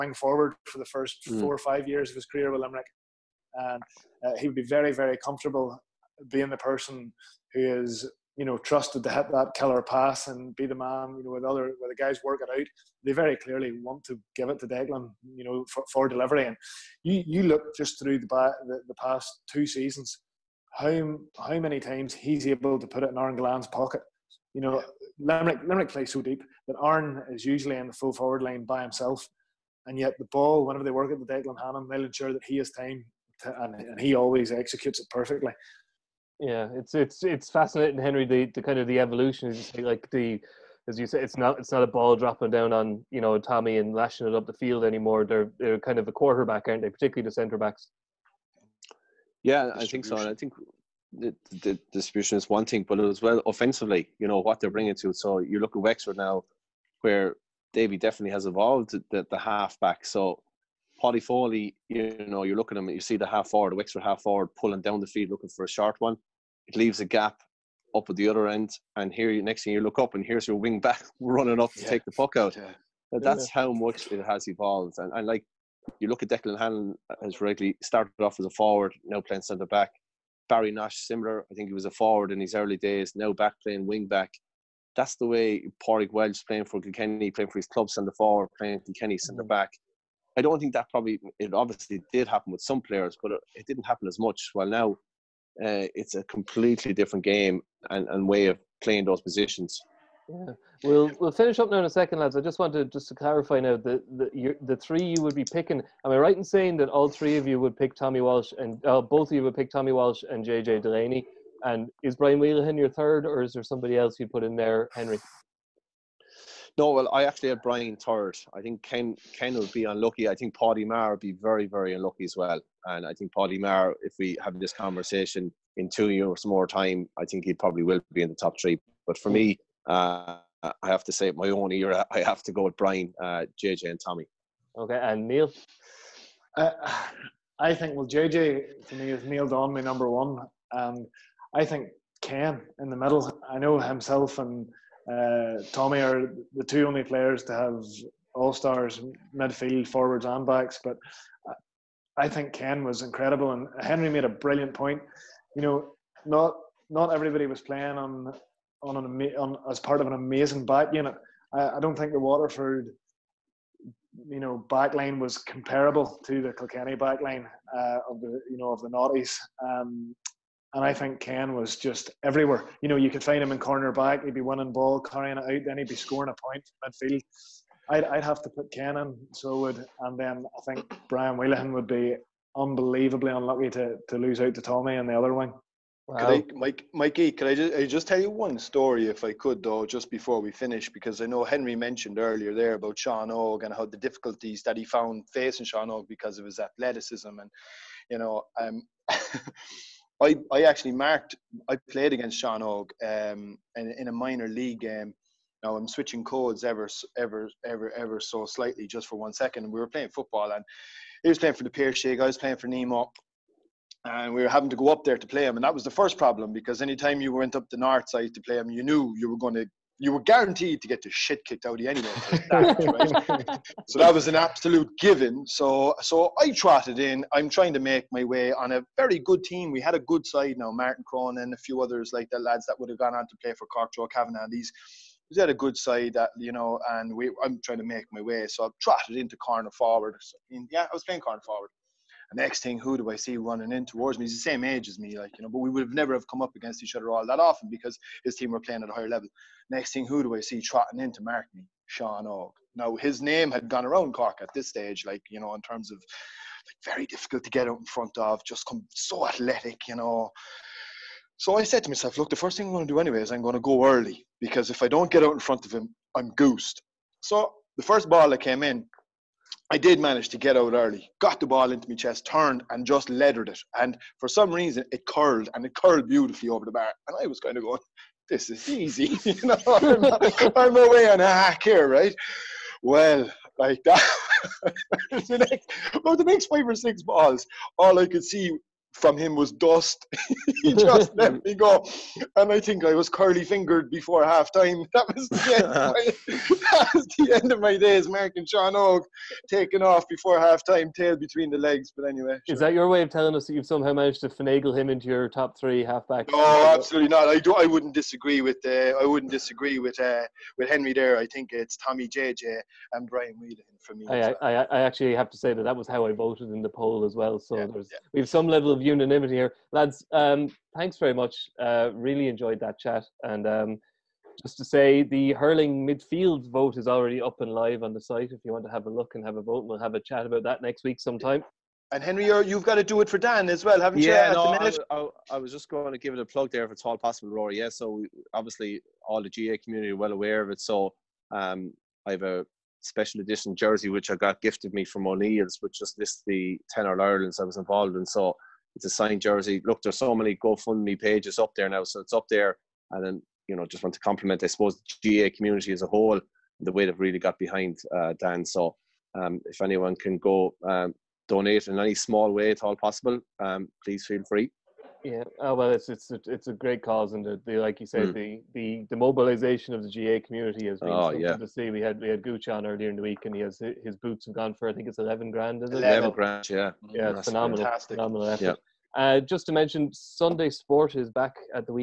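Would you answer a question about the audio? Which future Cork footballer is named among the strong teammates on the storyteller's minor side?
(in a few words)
Joe Kavanagh.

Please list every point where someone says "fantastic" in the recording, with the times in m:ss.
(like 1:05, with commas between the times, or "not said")
6:17.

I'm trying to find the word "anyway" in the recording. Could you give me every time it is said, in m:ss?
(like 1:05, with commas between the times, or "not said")
3:41, 4:22, 5:02.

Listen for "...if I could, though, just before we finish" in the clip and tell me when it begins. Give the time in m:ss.
3:09.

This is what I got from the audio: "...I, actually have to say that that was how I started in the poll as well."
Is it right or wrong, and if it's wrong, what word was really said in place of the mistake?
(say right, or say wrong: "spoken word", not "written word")
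wrong: "voted", not "started".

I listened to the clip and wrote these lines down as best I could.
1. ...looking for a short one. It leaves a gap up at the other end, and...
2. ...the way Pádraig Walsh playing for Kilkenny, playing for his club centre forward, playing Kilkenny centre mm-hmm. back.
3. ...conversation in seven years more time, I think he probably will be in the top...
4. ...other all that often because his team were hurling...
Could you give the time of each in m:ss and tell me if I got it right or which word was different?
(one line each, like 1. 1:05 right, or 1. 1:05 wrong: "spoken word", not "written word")
1. 1:05 right
2. 1:25 right
3. 2:04 wrong: "two", not "seven"
4. 4:06 wrong: "playing", not "hurling".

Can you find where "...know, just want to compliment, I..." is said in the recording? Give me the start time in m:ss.
5:53.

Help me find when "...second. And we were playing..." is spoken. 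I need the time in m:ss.
3:29.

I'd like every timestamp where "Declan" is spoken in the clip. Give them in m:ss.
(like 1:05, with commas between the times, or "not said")
0:14, 0:31, 1:16.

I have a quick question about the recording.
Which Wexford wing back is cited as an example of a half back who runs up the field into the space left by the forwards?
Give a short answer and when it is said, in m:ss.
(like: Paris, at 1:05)
Paudie Foley, at 1:01.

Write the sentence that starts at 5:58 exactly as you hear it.
So um, if anyone can go um, donate in any small way at all possible, um, please feel free.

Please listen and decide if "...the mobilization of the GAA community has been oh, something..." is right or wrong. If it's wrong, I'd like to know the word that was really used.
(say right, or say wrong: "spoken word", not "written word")
right.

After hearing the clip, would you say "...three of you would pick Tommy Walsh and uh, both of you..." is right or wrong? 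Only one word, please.
right.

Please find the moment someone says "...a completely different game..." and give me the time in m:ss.
1:36.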